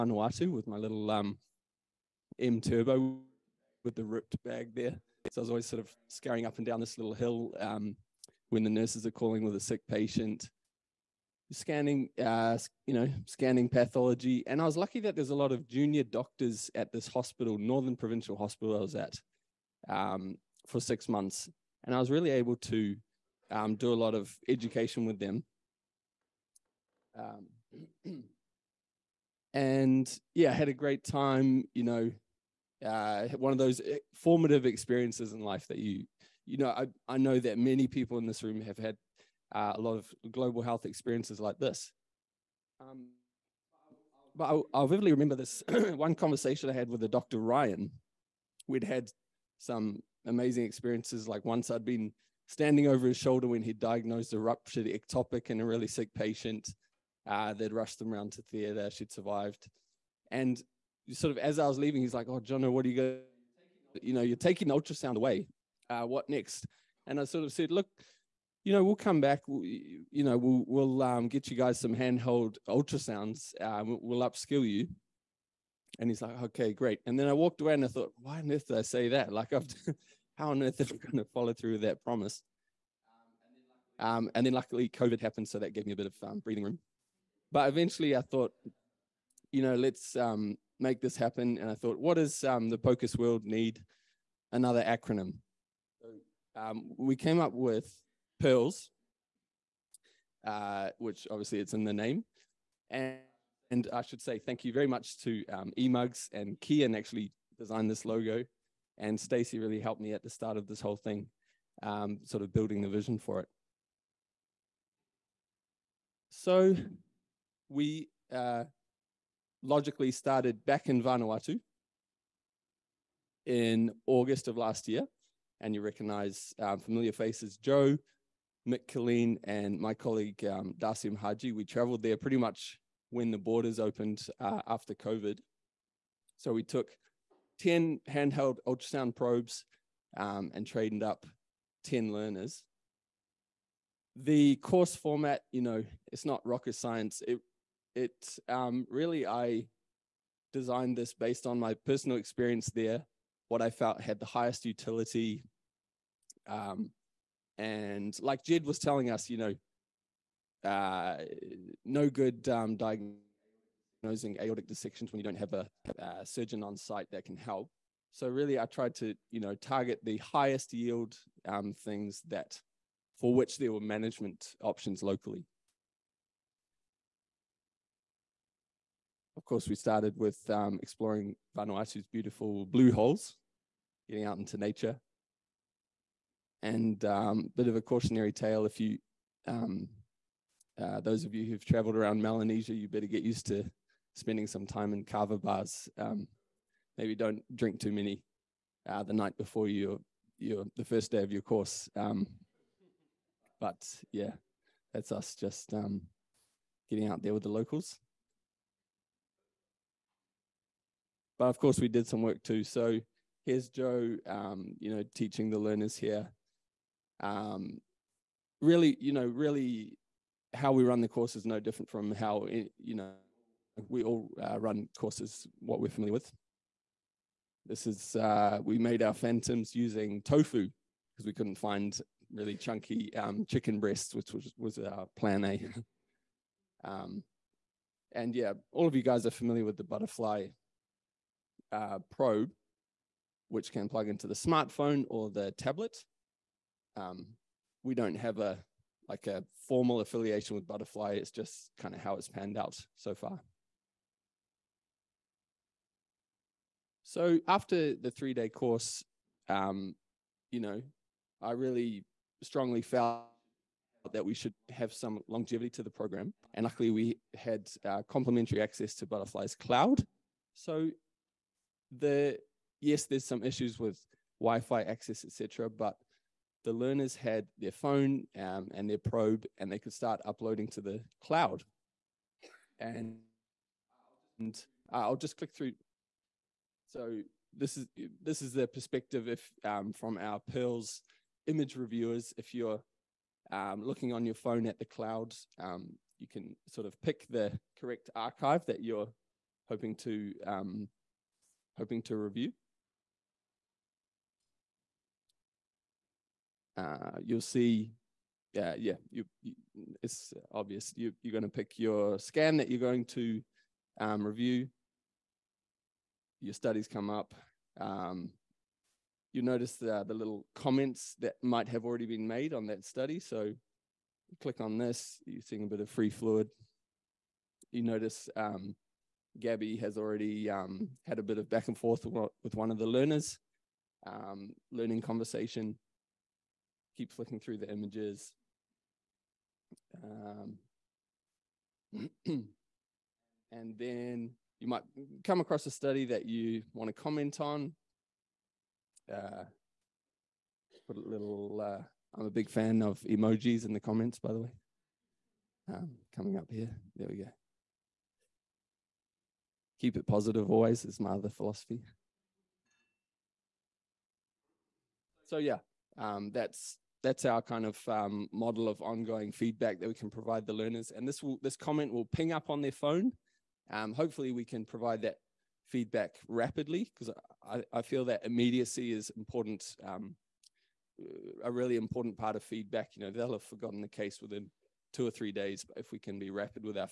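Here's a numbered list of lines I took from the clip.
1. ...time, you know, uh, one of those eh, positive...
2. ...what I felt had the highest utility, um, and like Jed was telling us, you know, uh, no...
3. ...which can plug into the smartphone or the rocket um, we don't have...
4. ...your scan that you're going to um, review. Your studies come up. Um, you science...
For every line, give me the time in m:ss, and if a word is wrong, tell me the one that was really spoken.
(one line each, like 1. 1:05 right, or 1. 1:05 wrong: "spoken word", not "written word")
1. 0:31 wrong: "formative", not "positive"
2. 2:33 right
3. 4:03 wrong: "tablet", not "rocket"
4. 5:11 wrong: "notice", not "science".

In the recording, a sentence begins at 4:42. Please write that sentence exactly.
And, and I'll just click through.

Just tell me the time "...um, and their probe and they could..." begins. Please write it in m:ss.
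4:38.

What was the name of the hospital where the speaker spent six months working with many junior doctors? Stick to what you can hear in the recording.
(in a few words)
Northern Provincial Hospital.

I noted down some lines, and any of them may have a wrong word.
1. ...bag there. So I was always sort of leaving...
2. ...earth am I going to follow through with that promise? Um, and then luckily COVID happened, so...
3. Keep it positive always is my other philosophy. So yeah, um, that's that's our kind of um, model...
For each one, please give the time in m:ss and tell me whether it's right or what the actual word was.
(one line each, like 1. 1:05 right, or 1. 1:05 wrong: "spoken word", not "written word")
1. 0:04 wrong: "scurrying", not "leaving"
2. 1:20 right
3. 5:59 right.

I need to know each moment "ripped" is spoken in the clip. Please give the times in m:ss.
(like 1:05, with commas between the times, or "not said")
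0:04.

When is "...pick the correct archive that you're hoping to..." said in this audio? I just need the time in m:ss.
4:57.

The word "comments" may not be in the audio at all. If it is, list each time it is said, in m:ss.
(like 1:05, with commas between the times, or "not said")
5:20, 5:47, 5:53, 6:11.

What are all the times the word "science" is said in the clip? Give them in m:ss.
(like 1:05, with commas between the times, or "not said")
2:26.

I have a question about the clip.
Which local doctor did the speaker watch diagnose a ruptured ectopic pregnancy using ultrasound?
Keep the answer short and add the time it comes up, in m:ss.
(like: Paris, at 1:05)
Dr. Ryan, at 0:47.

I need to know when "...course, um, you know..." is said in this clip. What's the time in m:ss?
4:18.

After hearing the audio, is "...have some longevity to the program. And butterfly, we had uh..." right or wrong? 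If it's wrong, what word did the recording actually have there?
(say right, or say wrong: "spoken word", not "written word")
wrong: "luckily", not "butterfly".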